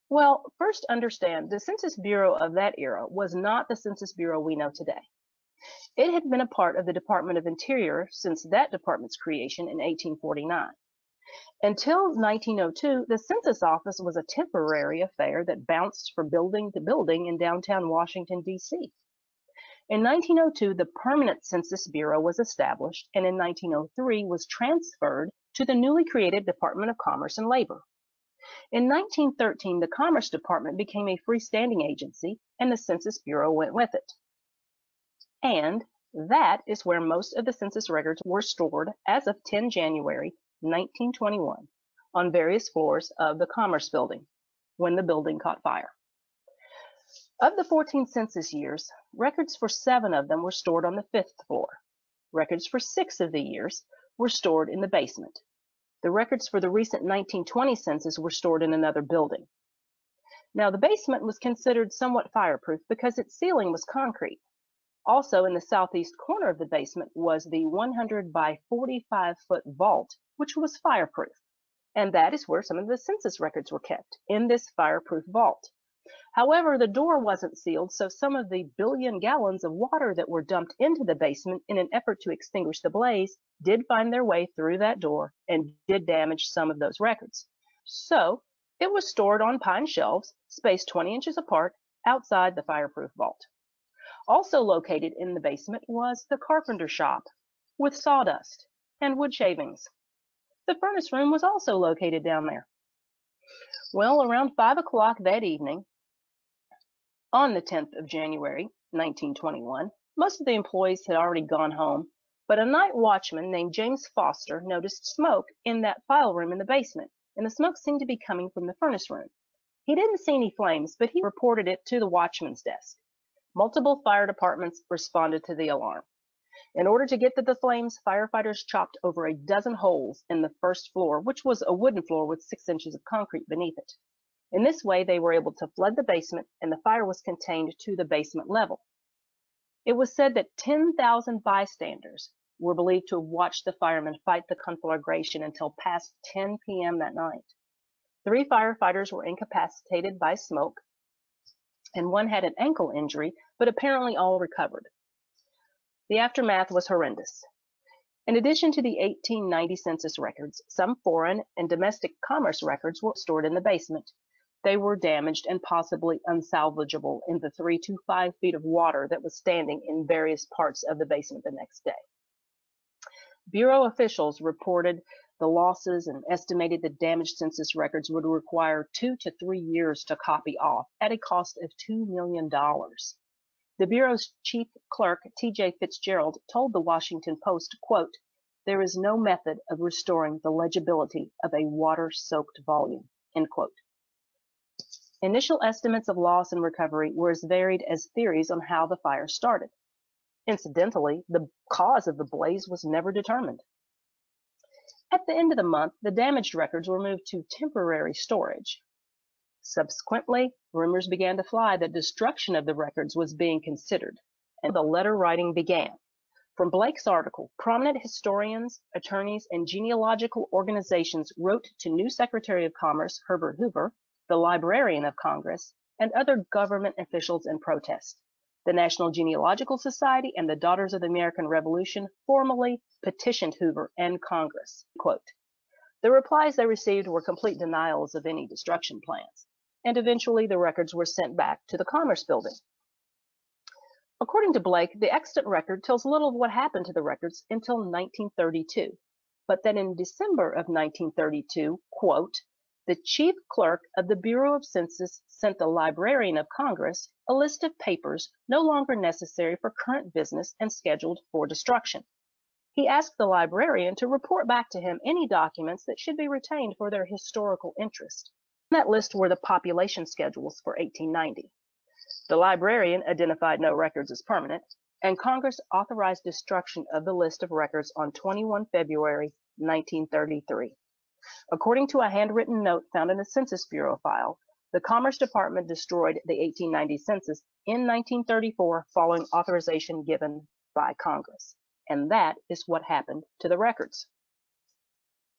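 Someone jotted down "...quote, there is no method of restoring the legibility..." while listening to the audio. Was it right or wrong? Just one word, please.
right.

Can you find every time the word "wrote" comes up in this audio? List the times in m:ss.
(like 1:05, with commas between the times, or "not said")
3:41.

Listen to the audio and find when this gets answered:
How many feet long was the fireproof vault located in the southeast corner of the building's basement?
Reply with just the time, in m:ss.
1:07.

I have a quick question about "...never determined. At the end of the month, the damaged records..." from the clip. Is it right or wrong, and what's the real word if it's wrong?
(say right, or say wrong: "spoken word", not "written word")
right.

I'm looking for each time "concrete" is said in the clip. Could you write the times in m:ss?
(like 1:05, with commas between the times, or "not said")
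1:03, 2:13.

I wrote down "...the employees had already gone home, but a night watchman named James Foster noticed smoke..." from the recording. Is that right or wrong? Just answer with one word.
right.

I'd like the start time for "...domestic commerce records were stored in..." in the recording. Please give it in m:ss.
2:41.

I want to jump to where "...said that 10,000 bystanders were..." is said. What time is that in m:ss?
2:20.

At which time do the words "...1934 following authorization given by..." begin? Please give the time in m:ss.
4:47.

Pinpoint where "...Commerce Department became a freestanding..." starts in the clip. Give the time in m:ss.
0:29.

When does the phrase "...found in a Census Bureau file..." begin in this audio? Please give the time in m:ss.
4:42.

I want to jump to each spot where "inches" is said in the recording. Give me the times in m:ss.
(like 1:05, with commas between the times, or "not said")
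1:31, 2:12.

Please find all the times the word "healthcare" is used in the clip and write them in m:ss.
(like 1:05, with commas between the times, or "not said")
not said.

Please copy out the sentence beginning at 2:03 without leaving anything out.
Multiple fire departments responded to the alarm.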